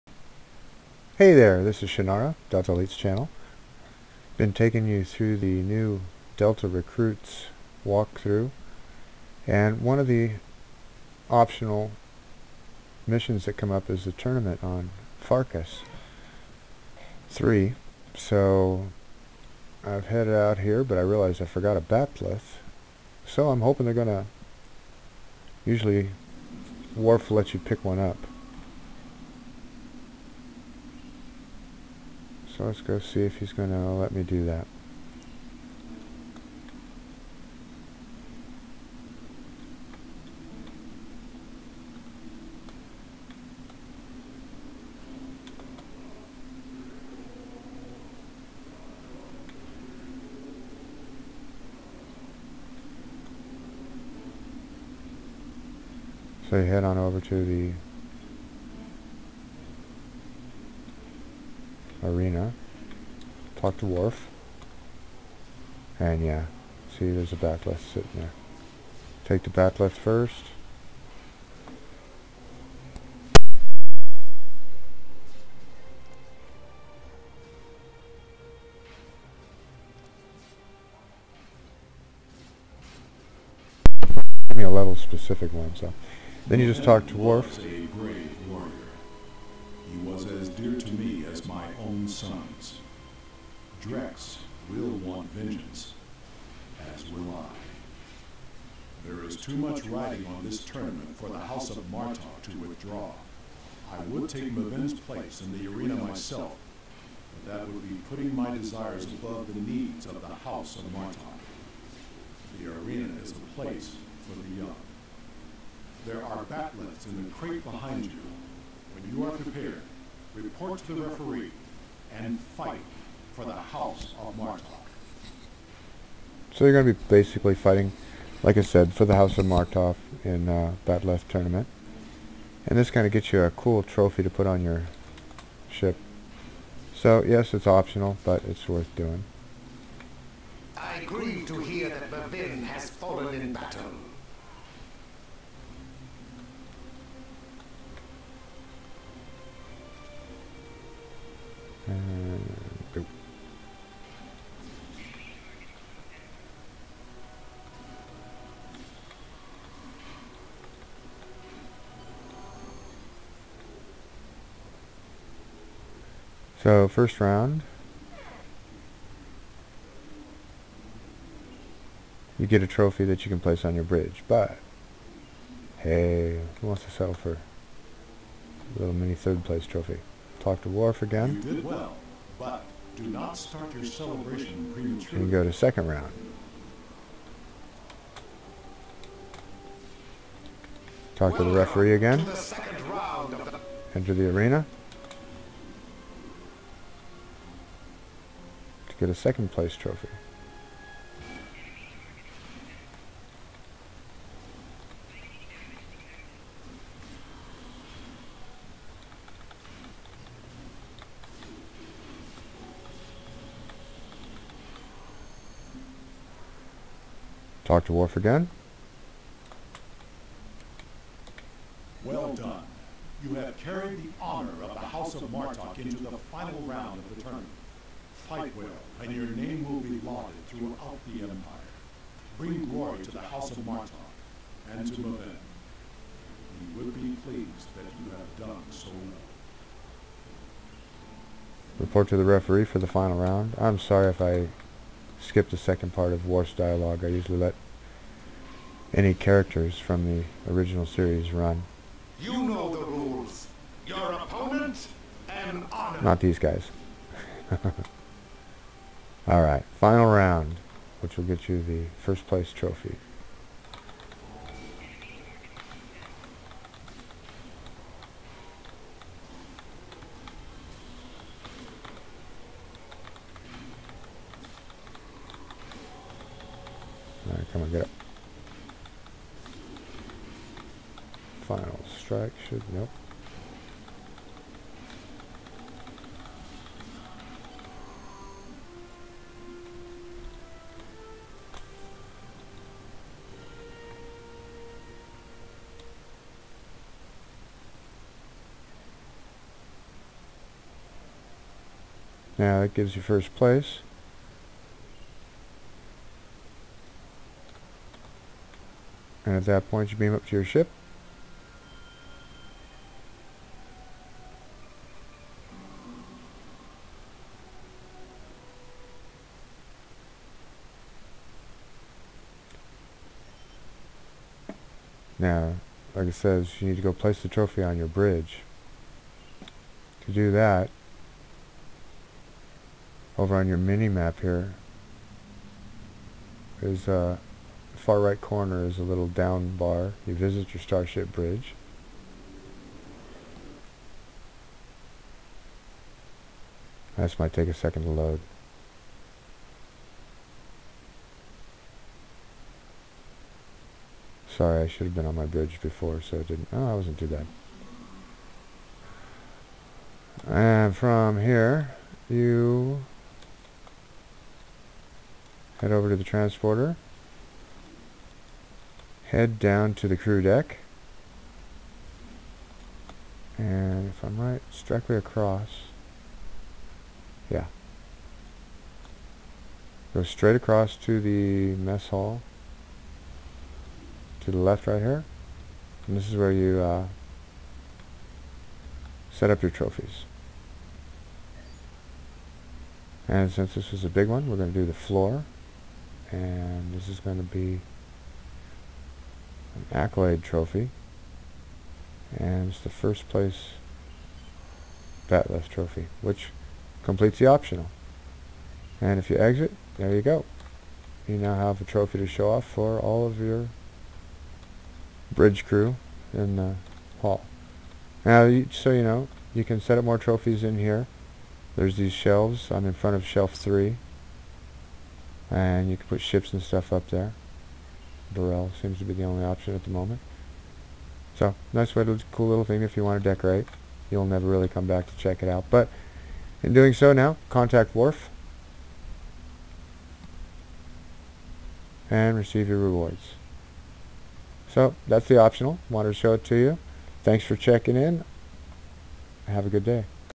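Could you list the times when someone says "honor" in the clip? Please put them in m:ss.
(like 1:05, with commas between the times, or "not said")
3:44, 4:15.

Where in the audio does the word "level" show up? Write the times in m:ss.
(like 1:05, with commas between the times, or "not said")
1:24.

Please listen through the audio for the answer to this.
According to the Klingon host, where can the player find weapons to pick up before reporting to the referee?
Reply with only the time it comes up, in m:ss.
1:57.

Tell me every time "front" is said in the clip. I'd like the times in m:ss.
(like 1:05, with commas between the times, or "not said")
7:02.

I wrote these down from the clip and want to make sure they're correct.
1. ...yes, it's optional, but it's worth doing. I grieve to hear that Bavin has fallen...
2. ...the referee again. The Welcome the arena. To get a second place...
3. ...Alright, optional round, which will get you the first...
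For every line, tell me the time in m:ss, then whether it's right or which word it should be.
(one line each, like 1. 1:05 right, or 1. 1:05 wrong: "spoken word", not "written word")
1. 2:17 right
2. 3:11 wrong: "Enter", not "Welcome"
3. 4:19 wrong: "final", not "optional".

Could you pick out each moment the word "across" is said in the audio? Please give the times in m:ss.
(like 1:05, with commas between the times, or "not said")
6:14, 6:20.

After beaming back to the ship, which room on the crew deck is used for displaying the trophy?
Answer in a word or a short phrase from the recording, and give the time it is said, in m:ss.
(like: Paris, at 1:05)
Mess hall, at 6:21.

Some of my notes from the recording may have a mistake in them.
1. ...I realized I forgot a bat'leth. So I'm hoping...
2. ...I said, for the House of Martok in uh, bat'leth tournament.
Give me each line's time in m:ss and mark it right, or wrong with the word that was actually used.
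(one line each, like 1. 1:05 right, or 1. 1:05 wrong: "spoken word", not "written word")
1. 0:20 right
2. 2:08 right.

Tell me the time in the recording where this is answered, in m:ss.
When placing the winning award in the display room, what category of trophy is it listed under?
6:39.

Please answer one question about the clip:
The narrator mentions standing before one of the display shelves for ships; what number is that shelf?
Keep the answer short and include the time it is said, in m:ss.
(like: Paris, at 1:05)
3, at 7:03.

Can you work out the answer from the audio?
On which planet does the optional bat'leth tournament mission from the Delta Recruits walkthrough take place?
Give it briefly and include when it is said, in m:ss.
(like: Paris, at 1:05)
Forcas 3, at 0:15.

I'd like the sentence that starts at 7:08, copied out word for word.
Burrell seems to be the only option at the moment.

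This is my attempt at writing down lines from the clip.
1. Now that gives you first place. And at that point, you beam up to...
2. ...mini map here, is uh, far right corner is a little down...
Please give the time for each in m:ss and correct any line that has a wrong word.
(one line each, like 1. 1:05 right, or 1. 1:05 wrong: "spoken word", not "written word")
1. 5:02 right
2. 5:33 right.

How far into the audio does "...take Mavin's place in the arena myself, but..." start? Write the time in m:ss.
1:44.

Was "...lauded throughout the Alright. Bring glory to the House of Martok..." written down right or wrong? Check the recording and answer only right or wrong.
wrong.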